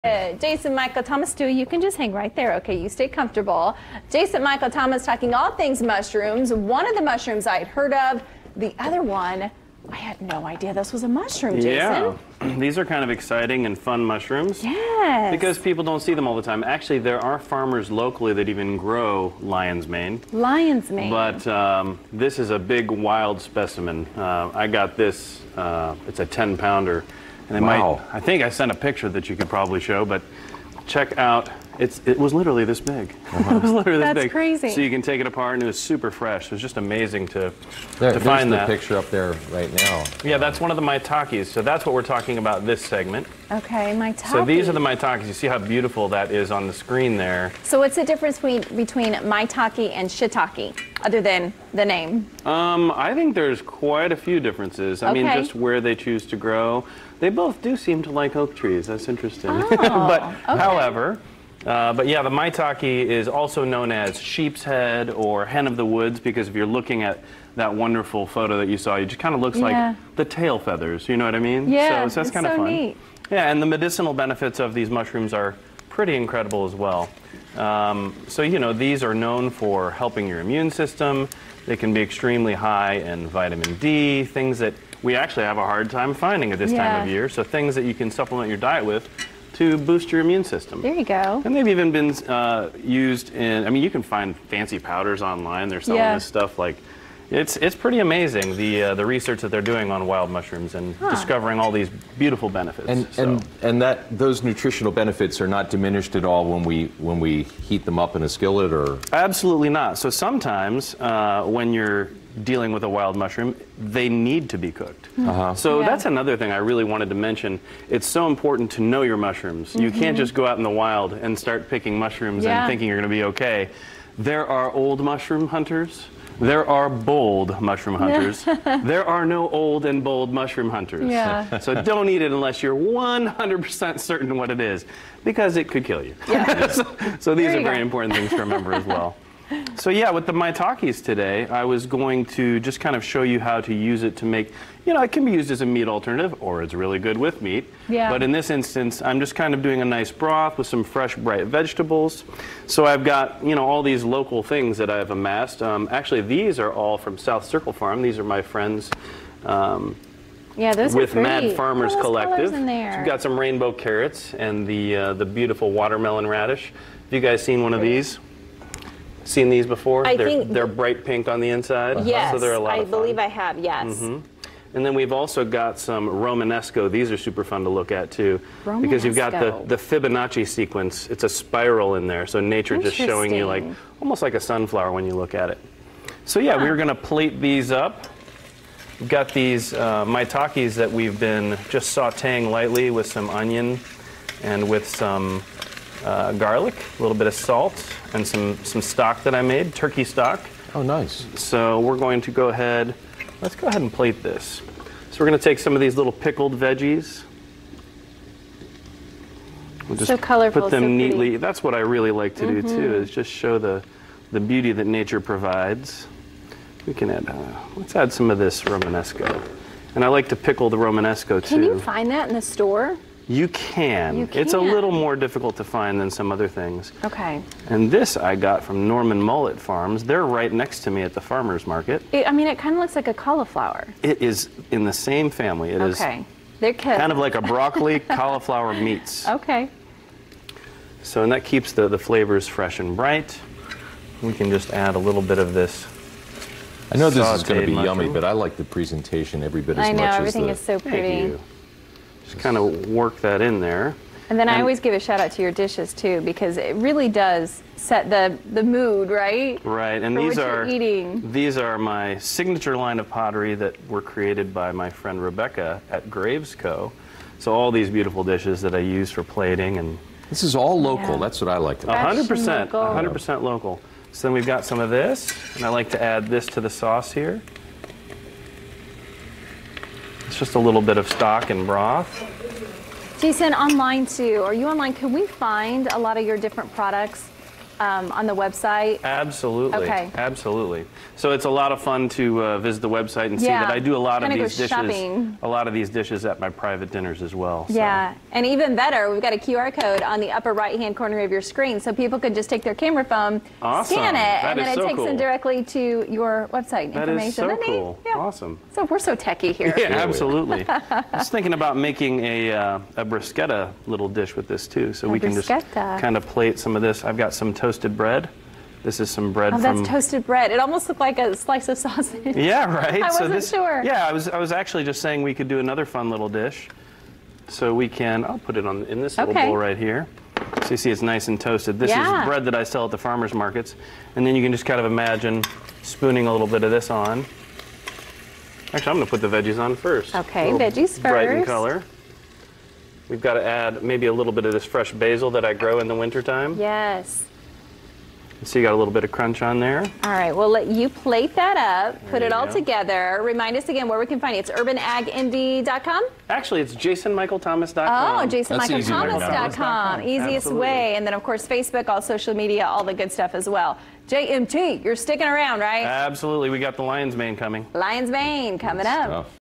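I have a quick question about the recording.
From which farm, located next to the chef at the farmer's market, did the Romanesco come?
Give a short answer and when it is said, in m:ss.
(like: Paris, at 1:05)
Norman Mullet Farms, at 3:48.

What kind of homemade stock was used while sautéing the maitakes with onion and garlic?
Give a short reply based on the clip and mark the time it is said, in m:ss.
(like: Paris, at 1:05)
turkey stock, at 3:19.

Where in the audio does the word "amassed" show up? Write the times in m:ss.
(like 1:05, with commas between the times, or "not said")
2:35.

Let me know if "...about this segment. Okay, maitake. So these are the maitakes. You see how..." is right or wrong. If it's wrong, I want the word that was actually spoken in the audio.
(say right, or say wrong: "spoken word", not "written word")
right.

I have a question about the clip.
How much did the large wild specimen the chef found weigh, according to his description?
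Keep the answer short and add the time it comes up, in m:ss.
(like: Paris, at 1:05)
10 pounds, at 0:26.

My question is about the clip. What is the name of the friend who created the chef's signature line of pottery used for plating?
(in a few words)
Rebecca.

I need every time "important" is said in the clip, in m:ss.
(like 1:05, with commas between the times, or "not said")
1:58, 2:17.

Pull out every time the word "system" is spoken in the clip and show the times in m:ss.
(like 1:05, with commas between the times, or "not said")
1:20, 1:30.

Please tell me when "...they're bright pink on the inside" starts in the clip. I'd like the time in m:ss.
2:50.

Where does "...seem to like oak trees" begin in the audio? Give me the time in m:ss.
0:57.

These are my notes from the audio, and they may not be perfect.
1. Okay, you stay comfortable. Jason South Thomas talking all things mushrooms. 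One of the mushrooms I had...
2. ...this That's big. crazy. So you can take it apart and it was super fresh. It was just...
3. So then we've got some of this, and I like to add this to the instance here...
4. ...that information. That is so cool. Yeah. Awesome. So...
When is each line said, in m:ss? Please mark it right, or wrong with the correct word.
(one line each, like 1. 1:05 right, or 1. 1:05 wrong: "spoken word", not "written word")
1. 0:02 wrong: "Michael", not "South"
2. 0:34 right
3. 4:34 wrong: "sauce", not "instance"
4. 5:06 right.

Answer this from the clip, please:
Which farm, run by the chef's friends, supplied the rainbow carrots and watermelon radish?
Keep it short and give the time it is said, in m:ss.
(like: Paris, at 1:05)
South Circle Farm, at 2:37.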